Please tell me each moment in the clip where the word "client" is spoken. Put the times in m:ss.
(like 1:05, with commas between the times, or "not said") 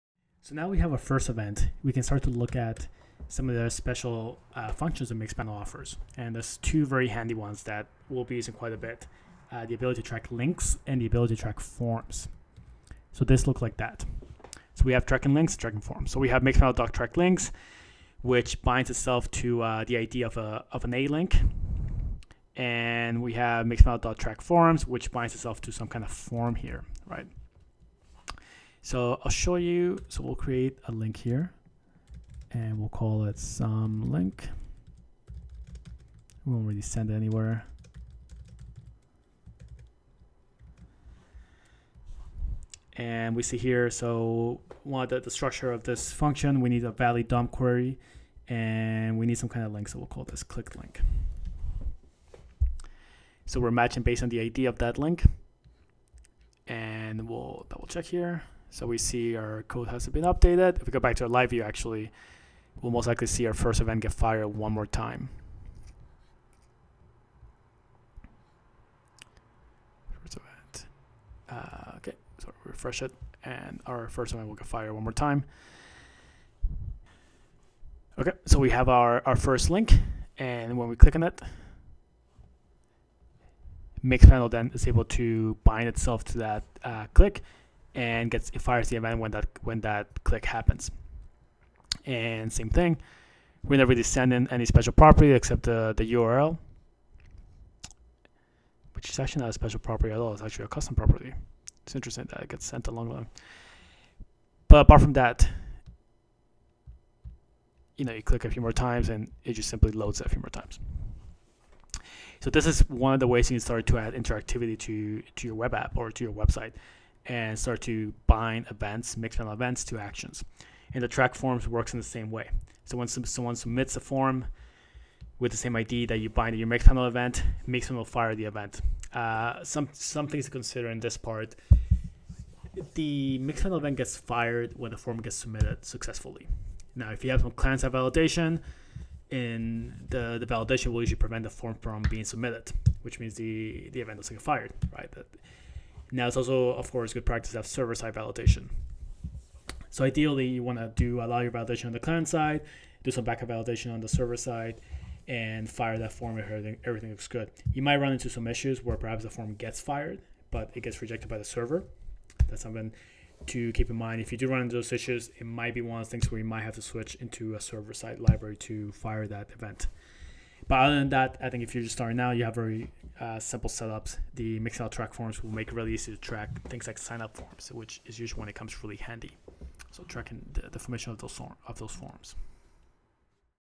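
2:17, 2:31.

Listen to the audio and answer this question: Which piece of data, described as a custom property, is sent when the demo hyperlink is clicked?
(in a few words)
The URL.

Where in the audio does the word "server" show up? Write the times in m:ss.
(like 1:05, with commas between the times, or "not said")
2:27, 2:34, 2:41, 2:47.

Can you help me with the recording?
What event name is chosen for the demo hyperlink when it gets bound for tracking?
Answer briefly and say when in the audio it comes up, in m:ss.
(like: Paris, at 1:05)
click link, at 0:50.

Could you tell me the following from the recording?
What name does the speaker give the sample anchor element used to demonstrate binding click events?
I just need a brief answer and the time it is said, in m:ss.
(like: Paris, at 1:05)
some link, at 0:33.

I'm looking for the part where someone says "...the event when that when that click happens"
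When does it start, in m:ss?
1:28.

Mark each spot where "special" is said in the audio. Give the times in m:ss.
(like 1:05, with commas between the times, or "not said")
0:03, 1:34, 1:39.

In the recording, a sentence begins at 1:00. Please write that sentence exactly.
If we go back to our live view, actually, we'll most likely see our first event get fired one more time.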